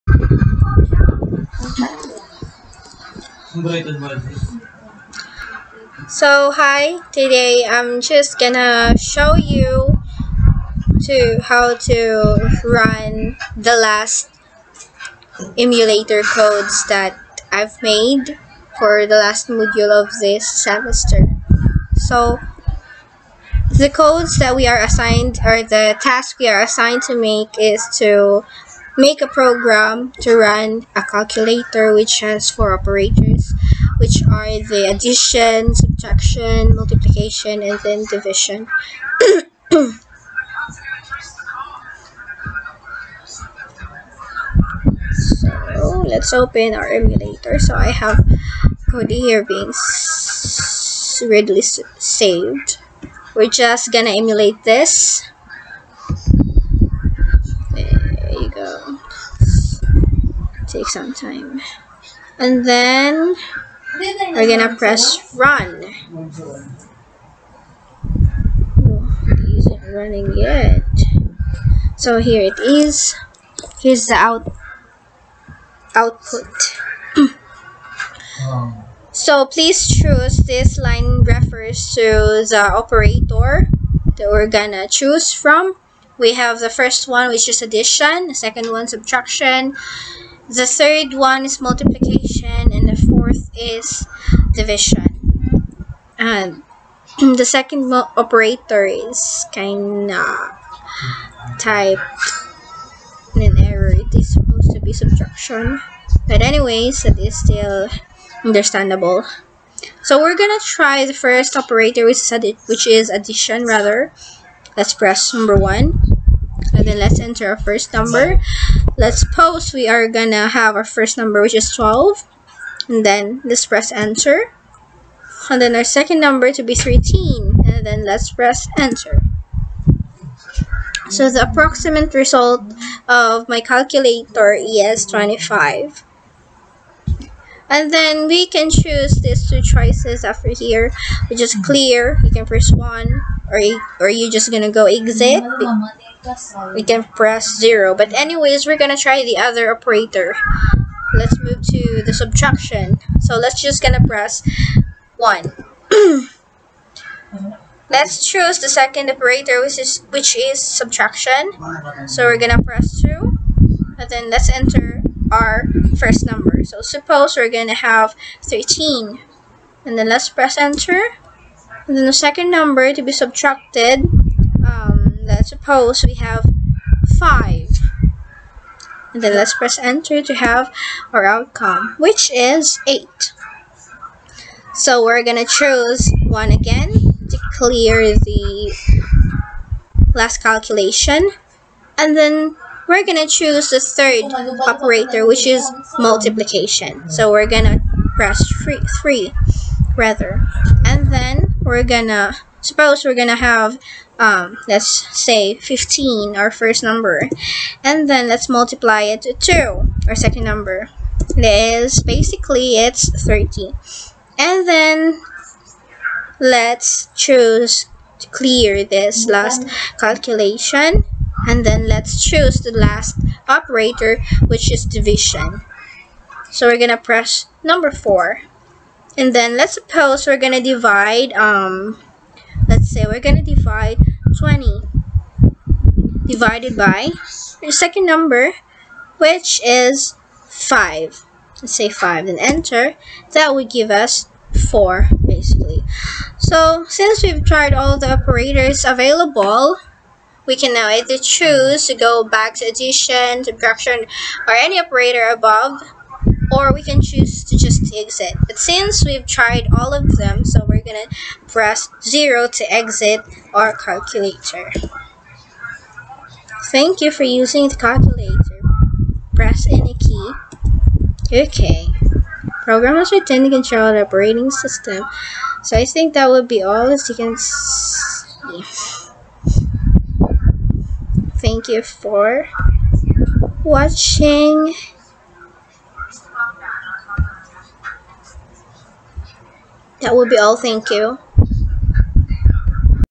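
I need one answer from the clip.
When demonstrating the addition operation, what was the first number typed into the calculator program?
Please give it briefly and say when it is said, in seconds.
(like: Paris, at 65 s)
12, at 121 s.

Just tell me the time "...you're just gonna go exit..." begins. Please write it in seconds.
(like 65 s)
144 s.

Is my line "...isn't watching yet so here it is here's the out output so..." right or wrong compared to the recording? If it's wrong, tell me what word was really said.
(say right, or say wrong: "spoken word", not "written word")
wrong: "running", not "watching".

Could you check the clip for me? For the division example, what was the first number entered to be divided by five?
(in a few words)
20.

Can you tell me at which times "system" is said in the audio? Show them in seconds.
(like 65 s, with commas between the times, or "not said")
274 s.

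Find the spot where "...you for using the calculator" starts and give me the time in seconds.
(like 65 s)
267 s.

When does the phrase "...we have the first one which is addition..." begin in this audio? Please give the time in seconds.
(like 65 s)
86 s.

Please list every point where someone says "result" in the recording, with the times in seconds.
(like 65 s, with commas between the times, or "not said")
132 s.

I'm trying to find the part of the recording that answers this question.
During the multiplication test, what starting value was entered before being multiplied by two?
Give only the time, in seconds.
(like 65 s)
205 s.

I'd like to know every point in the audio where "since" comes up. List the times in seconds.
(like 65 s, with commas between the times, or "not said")
246 s, 258 s.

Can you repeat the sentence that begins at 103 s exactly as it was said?
It is supposed to be subtraction.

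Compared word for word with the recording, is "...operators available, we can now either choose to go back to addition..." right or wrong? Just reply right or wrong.
right.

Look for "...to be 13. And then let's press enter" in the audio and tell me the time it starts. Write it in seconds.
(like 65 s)
126 s.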